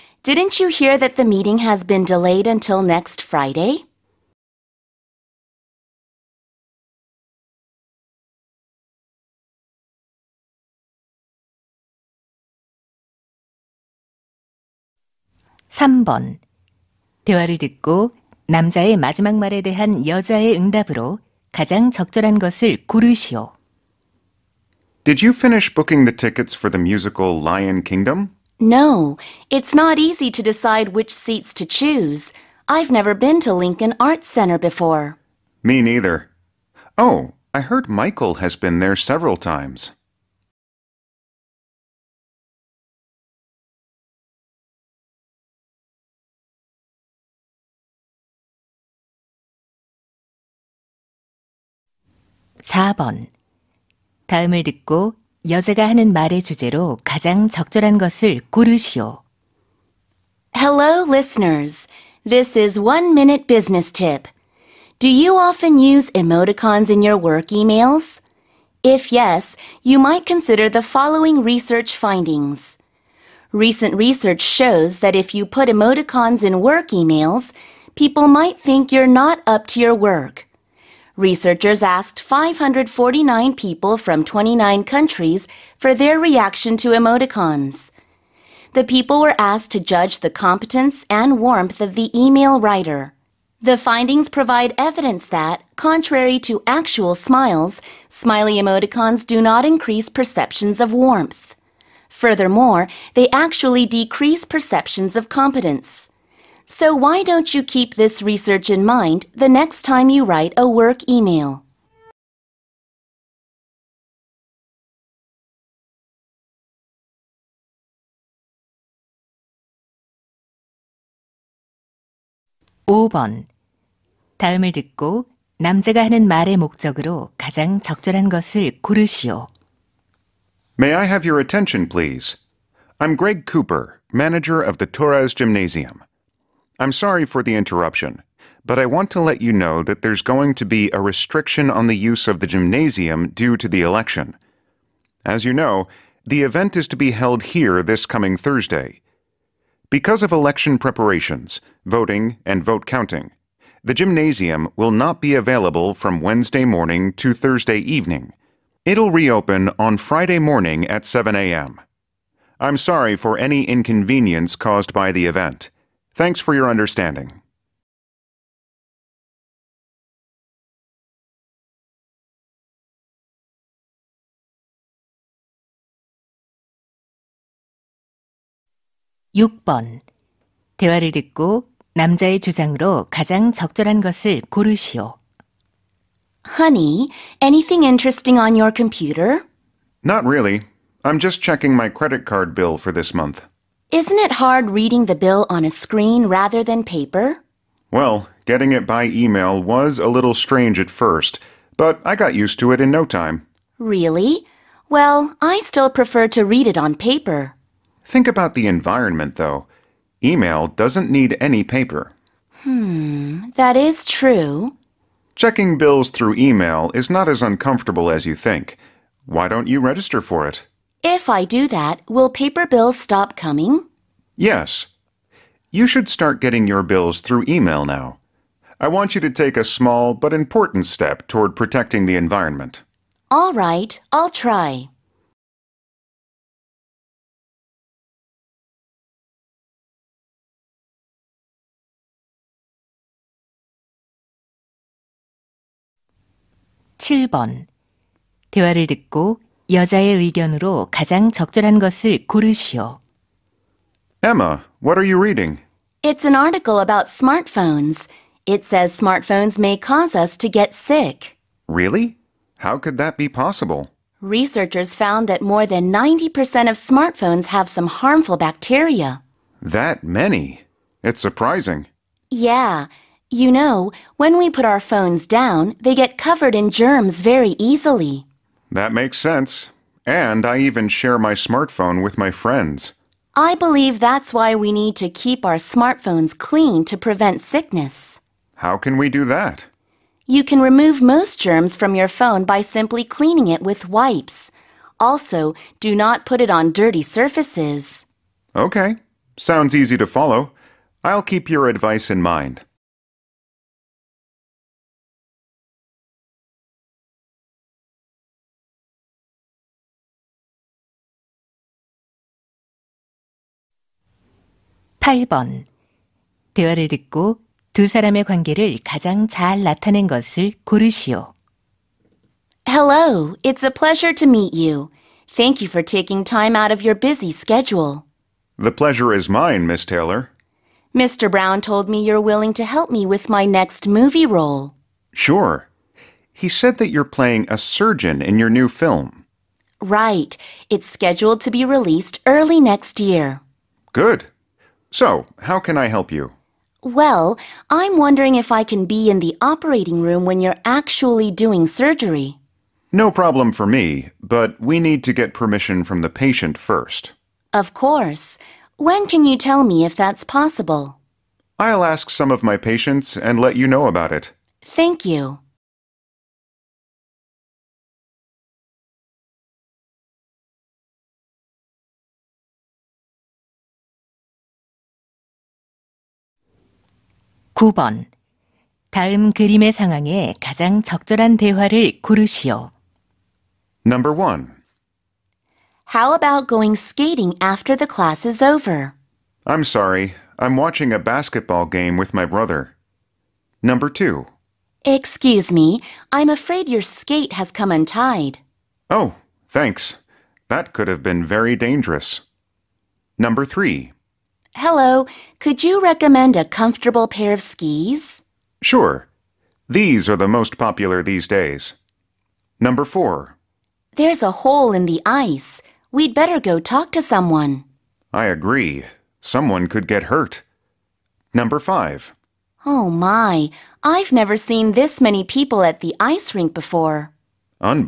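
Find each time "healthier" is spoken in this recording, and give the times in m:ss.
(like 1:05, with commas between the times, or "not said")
not said.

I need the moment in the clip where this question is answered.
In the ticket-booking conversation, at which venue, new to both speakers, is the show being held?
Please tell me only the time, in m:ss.
0:33.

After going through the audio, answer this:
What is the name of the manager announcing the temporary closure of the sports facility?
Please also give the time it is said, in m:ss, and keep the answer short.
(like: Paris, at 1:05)
Greg Cooper, at 2:13.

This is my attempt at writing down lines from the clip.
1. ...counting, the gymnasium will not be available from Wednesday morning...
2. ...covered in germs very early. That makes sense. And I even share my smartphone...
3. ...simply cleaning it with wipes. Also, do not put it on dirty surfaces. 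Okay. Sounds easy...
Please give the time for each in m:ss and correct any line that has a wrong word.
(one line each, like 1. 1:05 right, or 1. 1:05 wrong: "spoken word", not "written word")
1. 2:32 right
2. 4:36 wrong: "easily", not "early"
3. 4:52 right.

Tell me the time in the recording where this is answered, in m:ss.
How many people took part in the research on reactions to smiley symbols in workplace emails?
1:22.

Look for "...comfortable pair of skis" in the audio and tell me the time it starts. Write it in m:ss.
6:46.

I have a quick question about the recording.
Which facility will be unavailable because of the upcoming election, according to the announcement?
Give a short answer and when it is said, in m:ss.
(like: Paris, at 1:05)
Torres Gymnasium, at 2:14.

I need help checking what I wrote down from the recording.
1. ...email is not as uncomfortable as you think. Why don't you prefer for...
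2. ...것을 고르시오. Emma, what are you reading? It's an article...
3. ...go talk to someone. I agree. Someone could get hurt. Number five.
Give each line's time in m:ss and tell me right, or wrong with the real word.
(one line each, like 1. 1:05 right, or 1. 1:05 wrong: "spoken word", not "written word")
1. 3:36 wrong: "register", not "prefer"
2. 4:11 right
3. 6:56 right.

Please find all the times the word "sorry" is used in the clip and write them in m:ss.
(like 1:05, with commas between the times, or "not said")
2:16, 2:42, 6:29.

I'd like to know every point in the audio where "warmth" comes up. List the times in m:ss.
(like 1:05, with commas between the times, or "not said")
1:31, 1:40.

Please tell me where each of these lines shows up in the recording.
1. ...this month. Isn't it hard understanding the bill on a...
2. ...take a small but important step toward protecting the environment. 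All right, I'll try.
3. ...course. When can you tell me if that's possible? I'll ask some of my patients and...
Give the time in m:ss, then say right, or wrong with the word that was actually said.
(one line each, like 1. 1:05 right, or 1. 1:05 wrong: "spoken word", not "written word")
1. 3:12 wrong: "reading", not "understanding"
2. 3:49 right
3. 5:57 right.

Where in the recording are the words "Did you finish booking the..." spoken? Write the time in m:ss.
0:25.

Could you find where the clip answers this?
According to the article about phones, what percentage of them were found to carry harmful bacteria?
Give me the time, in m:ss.
4:25.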